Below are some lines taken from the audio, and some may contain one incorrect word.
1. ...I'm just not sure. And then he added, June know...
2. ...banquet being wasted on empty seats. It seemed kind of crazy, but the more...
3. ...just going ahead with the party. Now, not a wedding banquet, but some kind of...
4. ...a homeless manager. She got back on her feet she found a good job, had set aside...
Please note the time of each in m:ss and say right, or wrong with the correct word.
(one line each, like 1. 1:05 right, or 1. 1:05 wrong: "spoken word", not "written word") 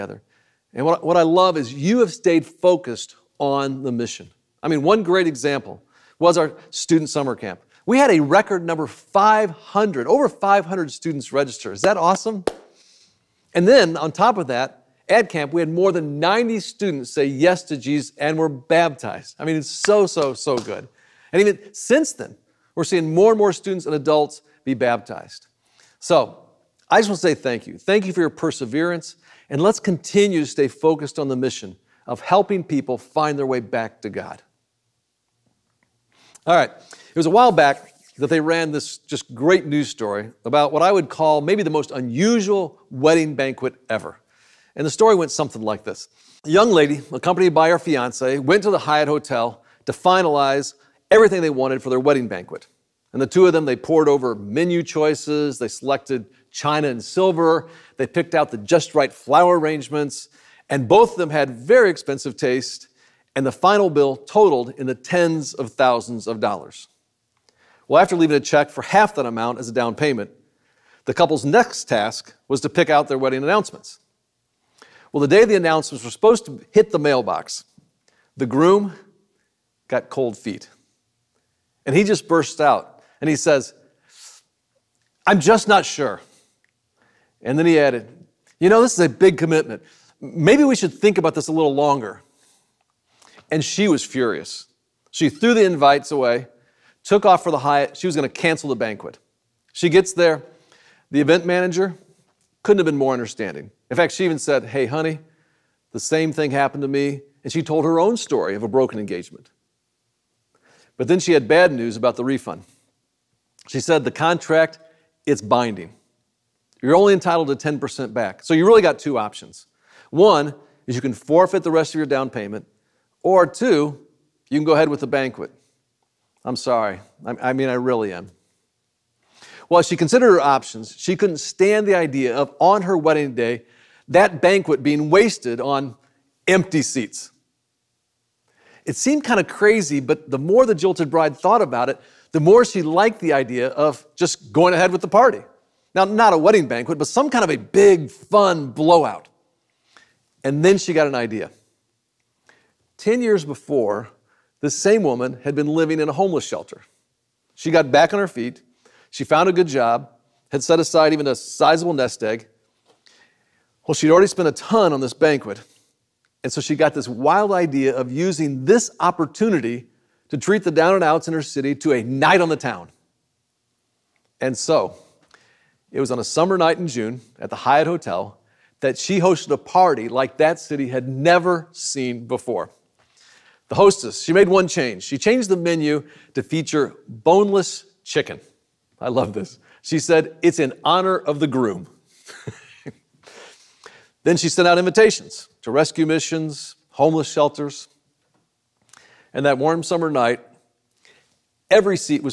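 1. 1:25 wrong: "You", not "June"
2. 2:14 right
3. 2:24 right
4. 2:36 wrong: "shelter", not "manager".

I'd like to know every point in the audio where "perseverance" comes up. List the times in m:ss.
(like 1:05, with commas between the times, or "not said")
0:28.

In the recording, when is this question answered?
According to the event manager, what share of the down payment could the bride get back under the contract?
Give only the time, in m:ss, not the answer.
1:57.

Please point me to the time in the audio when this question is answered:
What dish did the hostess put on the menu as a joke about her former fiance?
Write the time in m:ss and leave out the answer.
3:07.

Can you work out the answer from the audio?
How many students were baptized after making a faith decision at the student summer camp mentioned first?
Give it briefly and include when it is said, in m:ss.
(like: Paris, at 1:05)
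more than 90, at 0:15.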